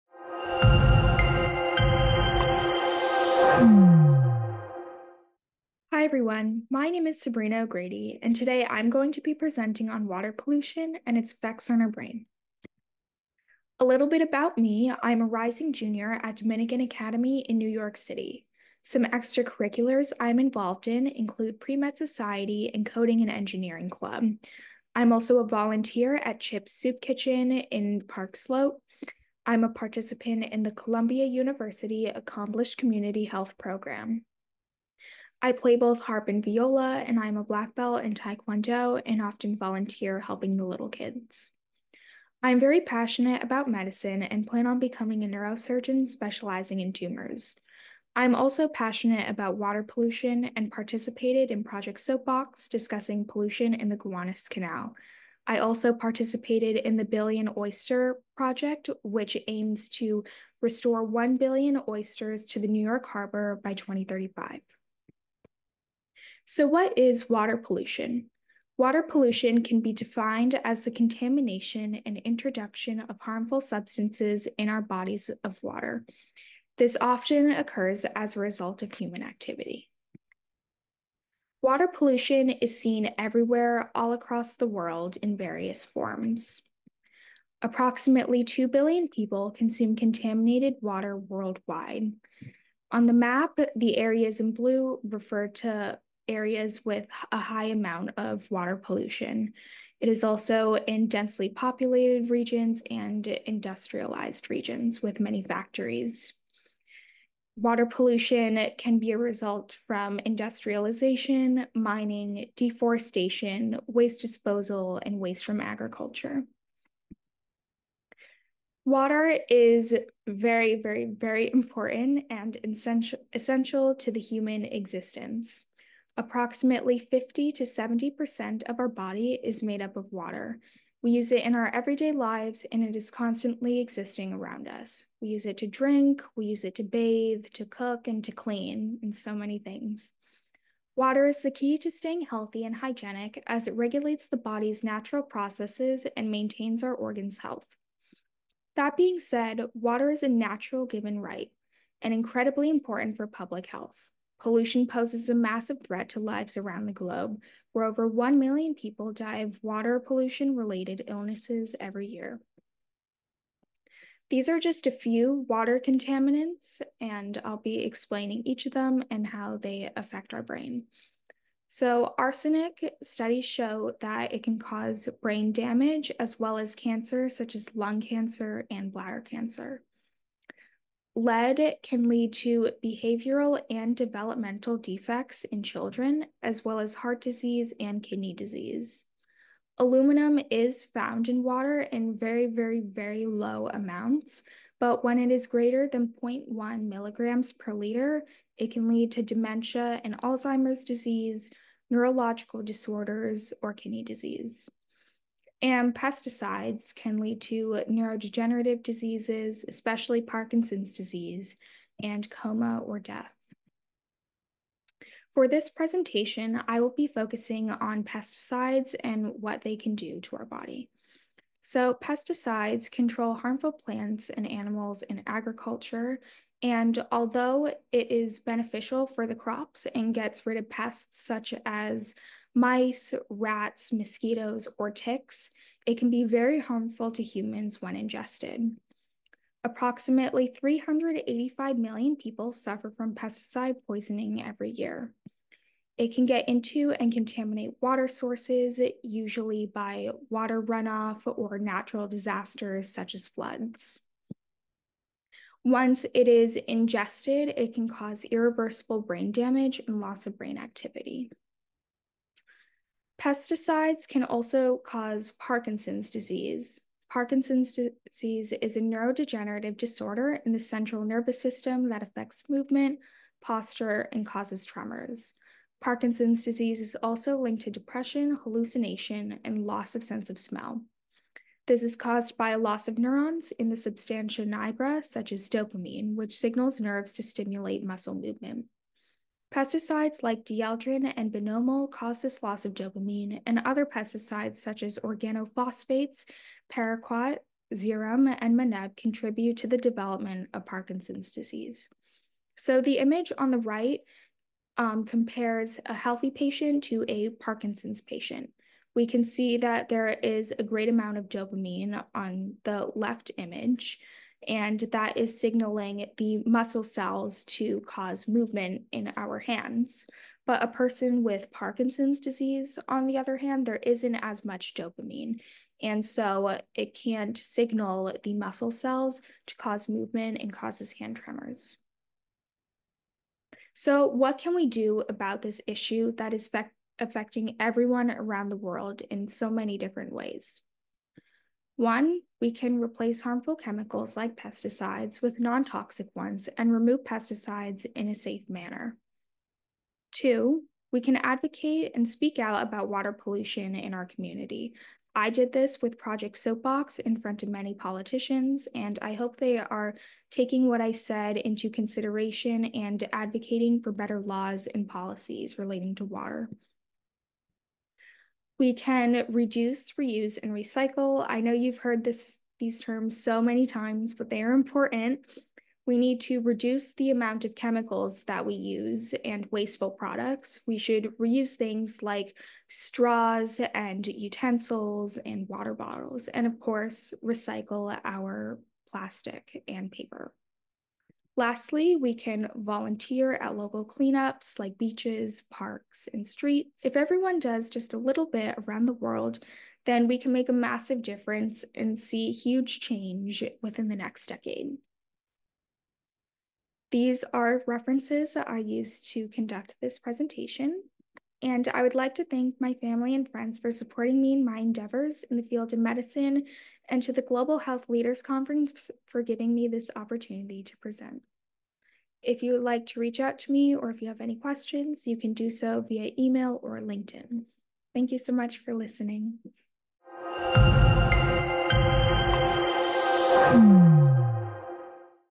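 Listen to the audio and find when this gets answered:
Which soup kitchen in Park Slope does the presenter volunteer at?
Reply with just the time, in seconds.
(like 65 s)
26 s.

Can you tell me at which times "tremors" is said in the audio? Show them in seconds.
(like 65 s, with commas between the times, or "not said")
274 s, 331 s.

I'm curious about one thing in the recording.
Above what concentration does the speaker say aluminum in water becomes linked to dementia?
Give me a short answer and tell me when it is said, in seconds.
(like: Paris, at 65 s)
0.1 milligrams per liter, at 196 s.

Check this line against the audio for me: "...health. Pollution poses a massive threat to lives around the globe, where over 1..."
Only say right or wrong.
right.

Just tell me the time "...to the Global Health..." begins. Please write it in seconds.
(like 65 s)
417 s.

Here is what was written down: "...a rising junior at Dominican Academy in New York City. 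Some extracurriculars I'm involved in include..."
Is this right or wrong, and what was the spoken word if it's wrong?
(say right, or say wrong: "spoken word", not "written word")
right.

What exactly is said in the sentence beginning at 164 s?
These are just a few water contaminants, and I'll be explaining each of them and how they affect our brain.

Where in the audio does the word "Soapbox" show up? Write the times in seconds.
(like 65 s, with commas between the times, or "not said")
52 s, 356 s.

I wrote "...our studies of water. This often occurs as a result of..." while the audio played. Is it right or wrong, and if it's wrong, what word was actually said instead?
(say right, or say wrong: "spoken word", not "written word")
wrong: "bodies", not "studies".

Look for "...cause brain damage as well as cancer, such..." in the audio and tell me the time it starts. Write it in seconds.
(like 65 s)
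174 s.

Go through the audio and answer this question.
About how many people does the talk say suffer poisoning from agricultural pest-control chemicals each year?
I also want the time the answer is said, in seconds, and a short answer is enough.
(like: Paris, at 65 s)
385 million, at 240 s.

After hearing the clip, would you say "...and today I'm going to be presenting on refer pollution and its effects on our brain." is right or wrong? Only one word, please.
wrong.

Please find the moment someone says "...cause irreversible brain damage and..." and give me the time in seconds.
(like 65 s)
257 s.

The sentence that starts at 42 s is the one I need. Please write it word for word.
I'm very passionate about medicine and plan on becoming a neurosurgeon specializing in tumors.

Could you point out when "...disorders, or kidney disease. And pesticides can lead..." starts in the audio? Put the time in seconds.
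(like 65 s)
202 s.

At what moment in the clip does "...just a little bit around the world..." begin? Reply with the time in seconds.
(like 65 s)
397 s.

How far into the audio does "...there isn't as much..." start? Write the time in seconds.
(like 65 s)
323 s.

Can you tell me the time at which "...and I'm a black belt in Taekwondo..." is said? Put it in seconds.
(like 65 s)
37 s.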